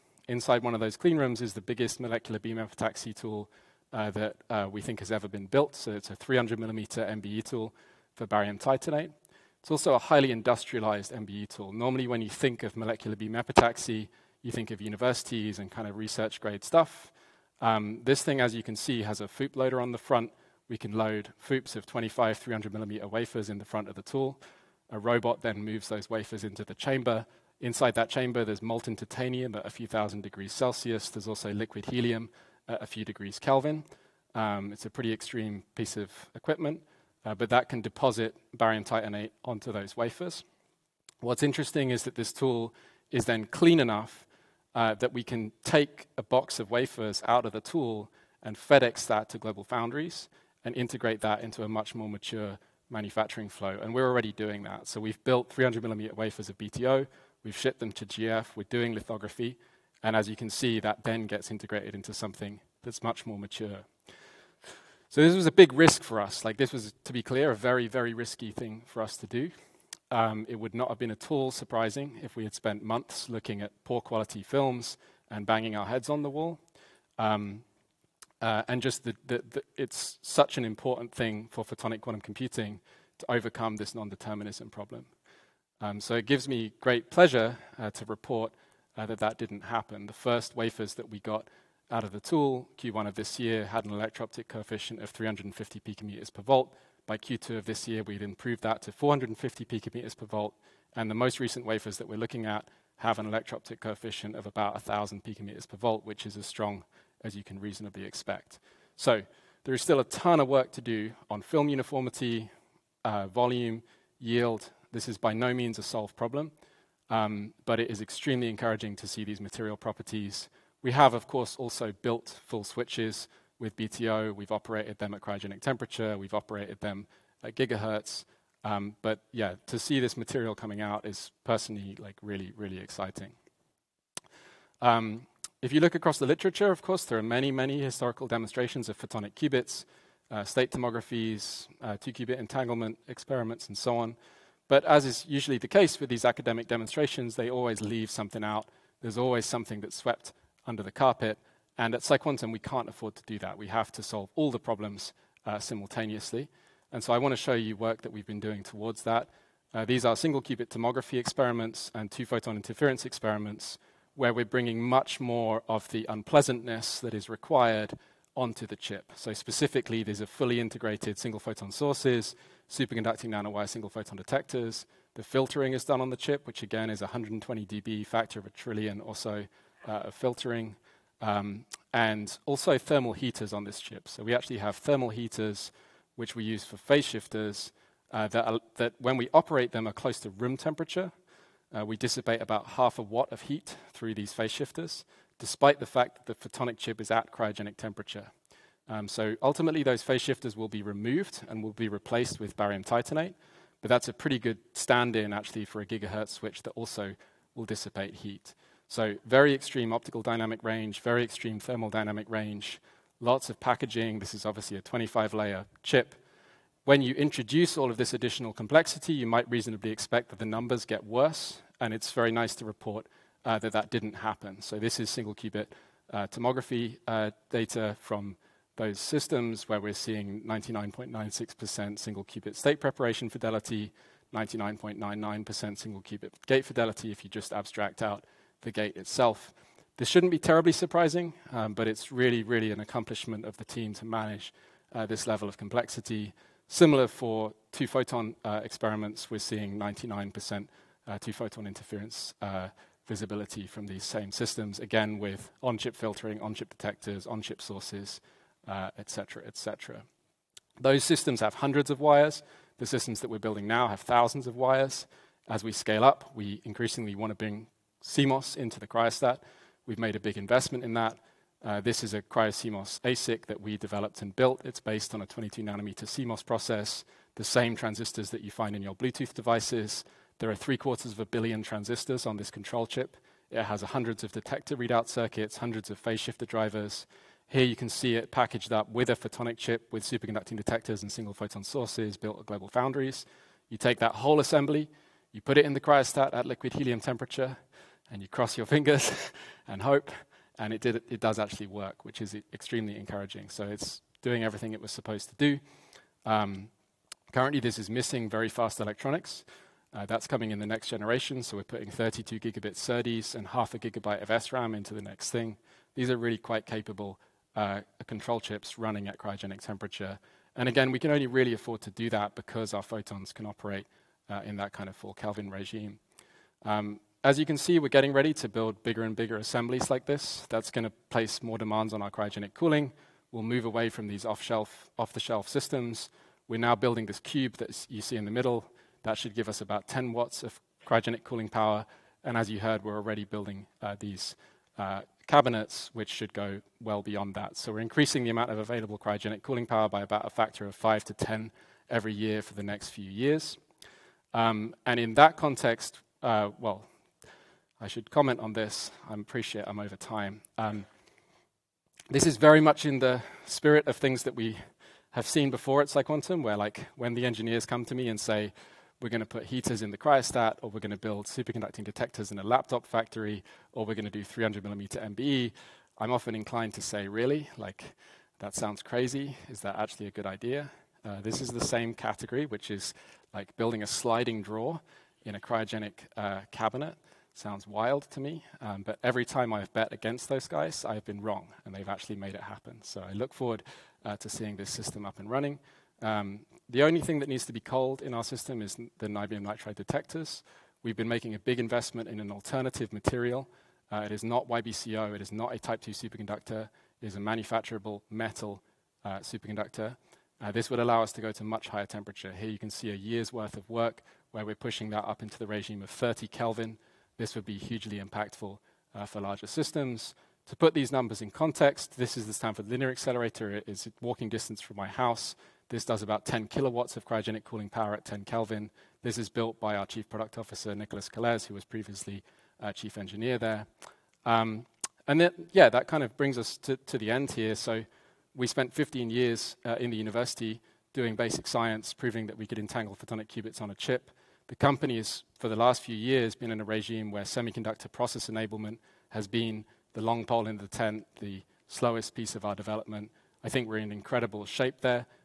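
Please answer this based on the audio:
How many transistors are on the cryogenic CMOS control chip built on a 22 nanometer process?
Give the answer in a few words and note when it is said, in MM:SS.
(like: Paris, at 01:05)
three quarters of a billion, at 04:40.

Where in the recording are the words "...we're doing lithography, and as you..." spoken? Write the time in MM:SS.
00:58.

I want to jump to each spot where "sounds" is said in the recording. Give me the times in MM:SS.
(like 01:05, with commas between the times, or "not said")
06:18, 06:27.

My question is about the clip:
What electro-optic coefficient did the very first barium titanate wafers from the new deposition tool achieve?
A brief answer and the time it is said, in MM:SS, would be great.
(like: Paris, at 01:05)
350 picometers per volt, at 01:35.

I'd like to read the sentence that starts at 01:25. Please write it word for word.
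Um, so it gives me great pleasure uh, to report uh, that that didn't happen.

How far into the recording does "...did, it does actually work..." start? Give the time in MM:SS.
05:00.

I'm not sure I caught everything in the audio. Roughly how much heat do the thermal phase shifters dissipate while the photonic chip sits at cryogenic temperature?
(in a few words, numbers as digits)
half a watt.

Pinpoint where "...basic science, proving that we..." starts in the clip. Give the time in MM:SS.
07:21.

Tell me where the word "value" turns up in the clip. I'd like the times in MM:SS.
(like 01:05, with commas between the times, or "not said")
not said.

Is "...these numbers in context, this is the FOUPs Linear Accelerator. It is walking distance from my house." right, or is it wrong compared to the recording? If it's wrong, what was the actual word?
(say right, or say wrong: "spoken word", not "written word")
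wrong: "Stanford", not "FOUPs".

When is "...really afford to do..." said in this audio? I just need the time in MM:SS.
05:21.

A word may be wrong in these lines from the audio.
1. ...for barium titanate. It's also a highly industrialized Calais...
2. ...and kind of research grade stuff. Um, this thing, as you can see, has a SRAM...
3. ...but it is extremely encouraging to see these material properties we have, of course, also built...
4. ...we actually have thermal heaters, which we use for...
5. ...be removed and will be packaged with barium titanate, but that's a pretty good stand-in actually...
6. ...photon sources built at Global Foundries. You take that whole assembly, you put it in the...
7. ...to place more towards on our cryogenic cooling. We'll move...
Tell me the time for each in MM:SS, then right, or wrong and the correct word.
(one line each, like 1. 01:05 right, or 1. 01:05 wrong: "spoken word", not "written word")
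1. 00:08 wrong: "MBE", not "Calais"
2. 00:15 wrong: "FOUP", not "SRAM"
3. 01:57 right
4. 03:04 right
5. 03:20 wrong: "replaced", not "packaged"
6. 04:51 right
7. 05:30 wrong: "demands", not "towards".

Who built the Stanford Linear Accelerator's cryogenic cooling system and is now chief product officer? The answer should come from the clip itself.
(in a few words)
Nicholas Calais.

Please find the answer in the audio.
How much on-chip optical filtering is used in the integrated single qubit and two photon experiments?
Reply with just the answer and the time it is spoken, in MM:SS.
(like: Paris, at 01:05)
120 dB, at 02:57.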